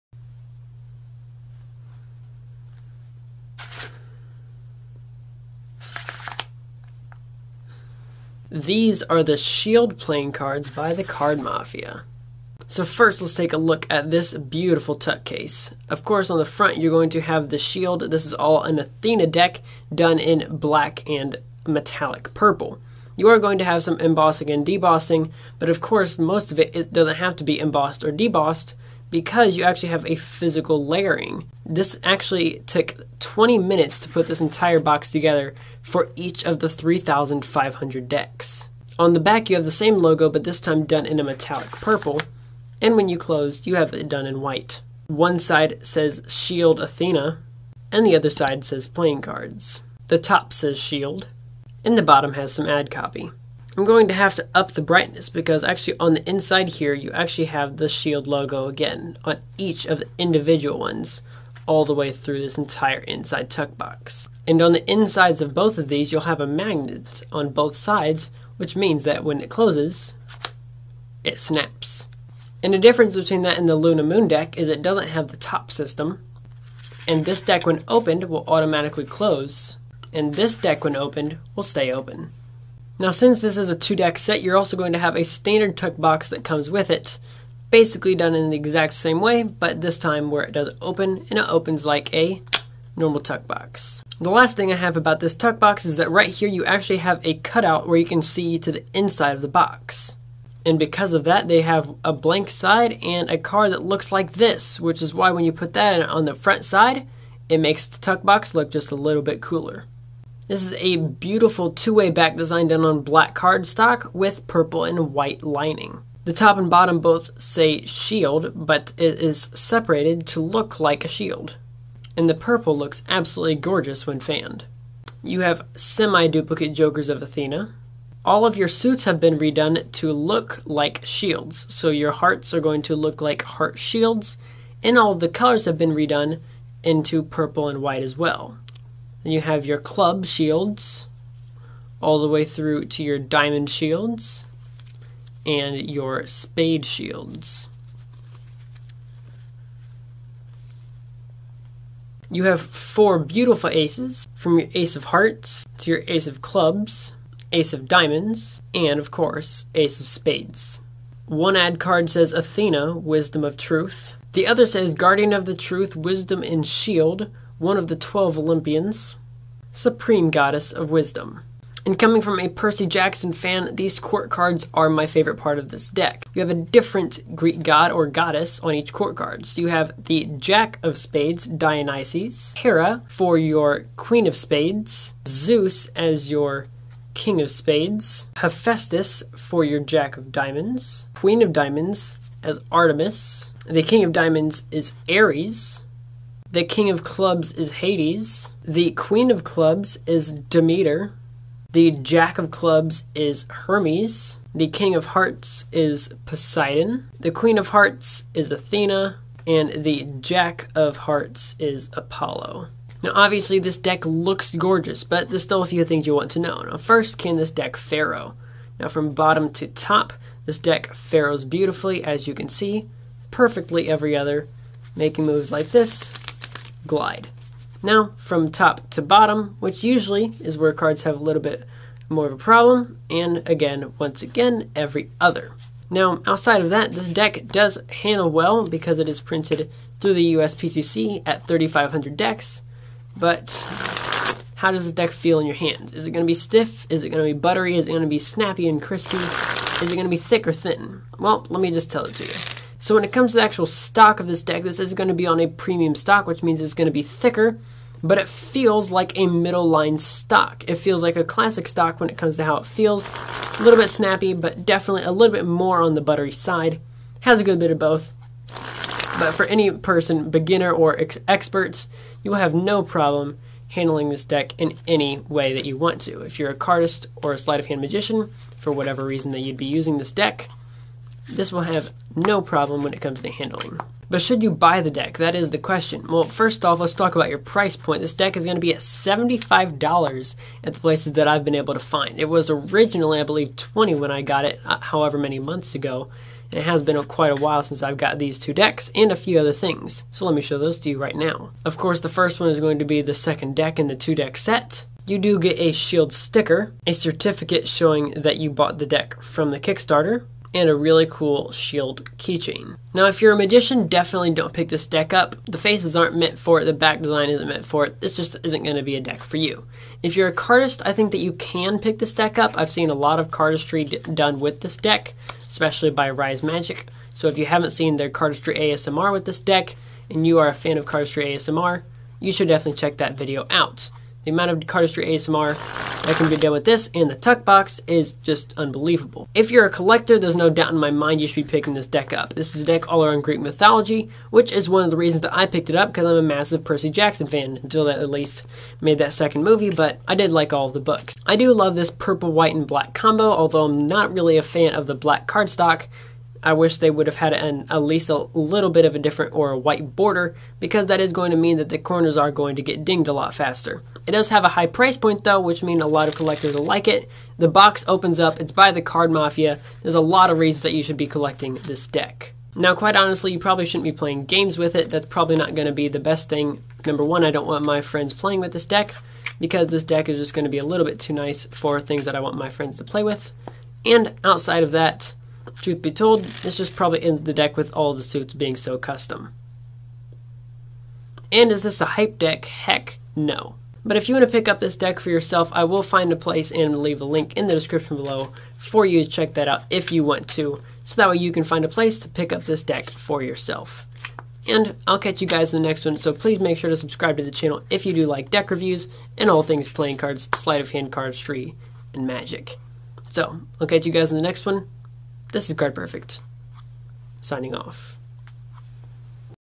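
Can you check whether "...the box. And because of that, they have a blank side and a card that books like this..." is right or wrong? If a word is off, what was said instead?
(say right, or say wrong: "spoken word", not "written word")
wrong: "looks", not "books".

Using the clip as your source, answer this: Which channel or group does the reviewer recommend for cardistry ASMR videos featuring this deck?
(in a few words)
Rise Magic.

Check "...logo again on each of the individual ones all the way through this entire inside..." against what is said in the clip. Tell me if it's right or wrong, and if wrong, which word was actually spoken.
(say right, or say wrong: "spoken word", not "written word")
right.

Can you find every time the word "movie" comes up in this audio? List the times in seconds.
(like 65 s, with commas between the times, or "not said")
349 s.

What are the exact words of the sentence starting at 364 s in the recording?
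It does have a high price point though, which means a lot of collectors will like it.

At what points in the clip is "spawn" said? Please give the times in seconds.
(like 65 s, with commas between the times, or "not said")
not said.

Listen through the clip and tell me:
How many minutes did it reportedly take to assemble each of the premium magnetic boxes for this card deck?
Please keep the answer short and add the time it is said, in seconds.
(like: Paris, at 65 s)
20 minutes, at 33 s.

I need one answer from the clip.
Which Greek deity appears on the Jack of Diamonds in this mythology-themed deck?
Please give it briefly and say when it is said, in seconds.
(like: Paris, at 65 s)
Hephaestus, at 188 s.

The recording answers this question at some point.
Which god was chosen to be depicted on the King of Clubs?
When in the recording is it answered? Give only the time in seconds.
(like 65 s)
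196 s.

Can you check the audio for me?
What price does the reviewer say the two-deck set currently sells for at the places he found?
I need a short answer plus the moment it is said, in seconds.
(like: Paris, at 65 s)
$75, at 288 s.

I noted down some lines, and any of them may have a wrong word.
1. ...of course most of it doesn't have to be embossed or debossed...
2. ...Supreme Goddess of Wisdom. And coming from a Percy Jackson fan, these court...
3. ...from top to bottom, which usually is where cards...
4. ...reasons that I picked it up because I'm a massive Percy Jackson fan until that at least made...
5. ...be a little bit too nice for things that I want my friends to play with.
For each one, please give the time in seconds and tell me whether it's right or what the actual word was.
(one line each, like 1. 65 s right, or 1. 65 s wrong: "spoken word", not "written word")
1. 25 s right
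2. 169 s right
3. 228 s right
4. 344 s right
5. 380 s right.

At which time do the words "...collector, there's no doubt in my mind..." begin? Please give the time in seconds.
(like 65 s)
339 s.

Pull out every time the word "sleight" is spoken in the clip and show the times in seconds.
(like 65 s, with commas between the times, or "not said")
277 s, 410 s.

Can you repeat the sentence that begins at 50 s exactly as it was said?
The top says Shield, and the bottom has some ad copy.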